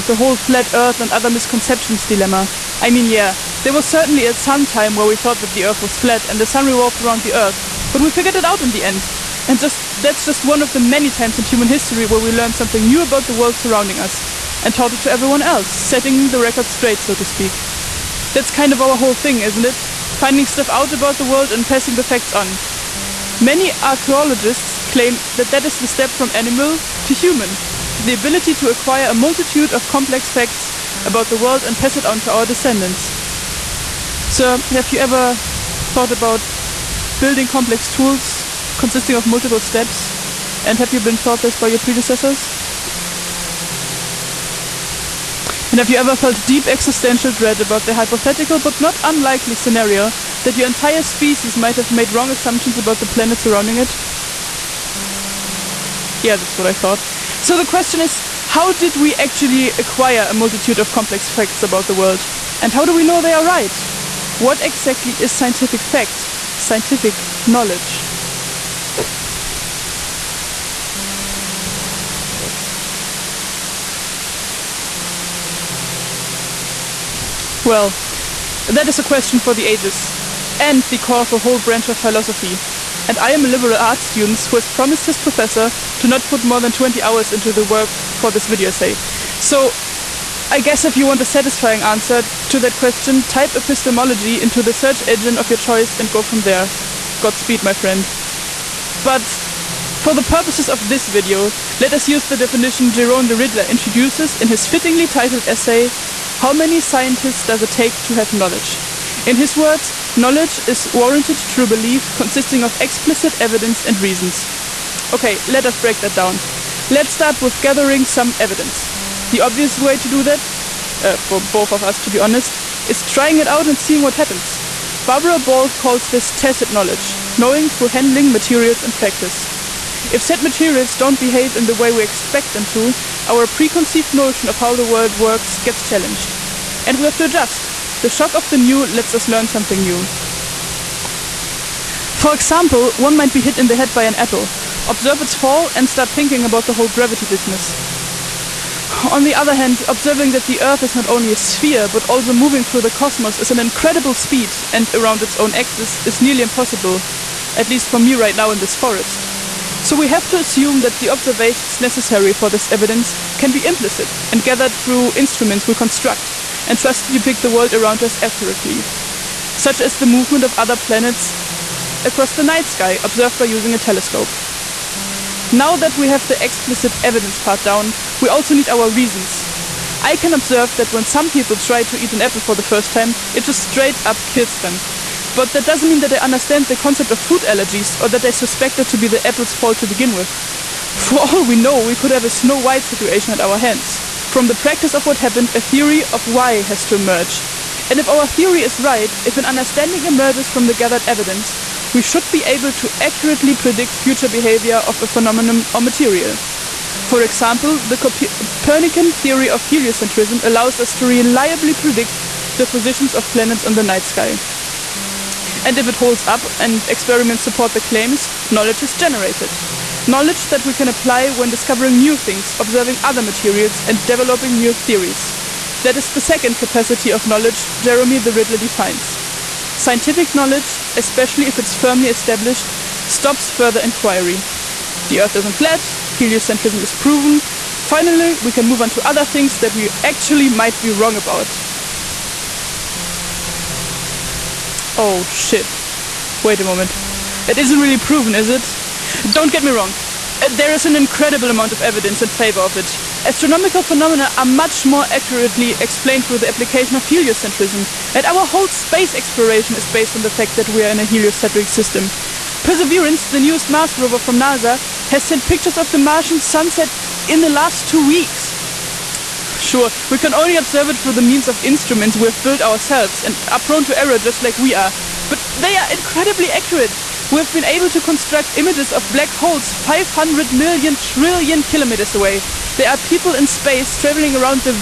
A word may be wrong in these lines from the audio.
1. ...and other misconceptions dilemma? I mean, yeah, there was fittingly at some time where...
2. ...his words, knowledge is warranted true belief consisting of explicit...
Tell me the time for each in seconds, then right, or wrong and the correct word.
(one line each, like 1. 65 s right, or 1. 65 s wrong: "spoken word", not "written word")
1. 0 s wrong: "certainly", not "fittingly"
2. 109 s right.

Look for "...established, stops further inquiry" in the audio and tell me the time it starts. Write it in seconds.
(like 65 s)
232 s.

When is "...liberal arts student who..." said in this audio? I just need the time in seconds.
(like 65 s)
83 s.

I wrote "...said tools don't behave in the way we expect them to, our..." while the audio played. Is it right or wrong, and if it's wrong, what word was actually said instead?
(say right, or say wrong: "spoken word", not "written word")
wrong: "materials", not "tools".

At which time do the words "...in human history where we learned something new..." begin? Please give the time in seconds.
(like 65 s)
11 s.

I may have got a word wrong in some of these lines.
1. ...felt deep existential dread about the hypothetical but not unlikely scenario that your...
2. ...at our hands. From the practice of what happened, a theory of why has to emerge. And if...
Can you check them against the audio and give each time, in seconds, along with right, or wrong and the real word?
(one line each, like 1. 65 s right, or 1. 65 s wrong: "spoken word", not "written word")
1. 46 s right
2. 193 s right.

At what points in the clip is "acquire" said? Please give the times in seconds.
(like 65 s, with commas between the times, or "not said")
28 s, 59 s.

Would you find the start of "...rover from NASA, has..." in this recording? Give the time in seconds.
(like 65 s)
263 s.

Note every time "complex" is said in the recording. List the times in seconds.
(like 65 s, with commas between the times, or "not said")
29 s, 37 s, 60 s.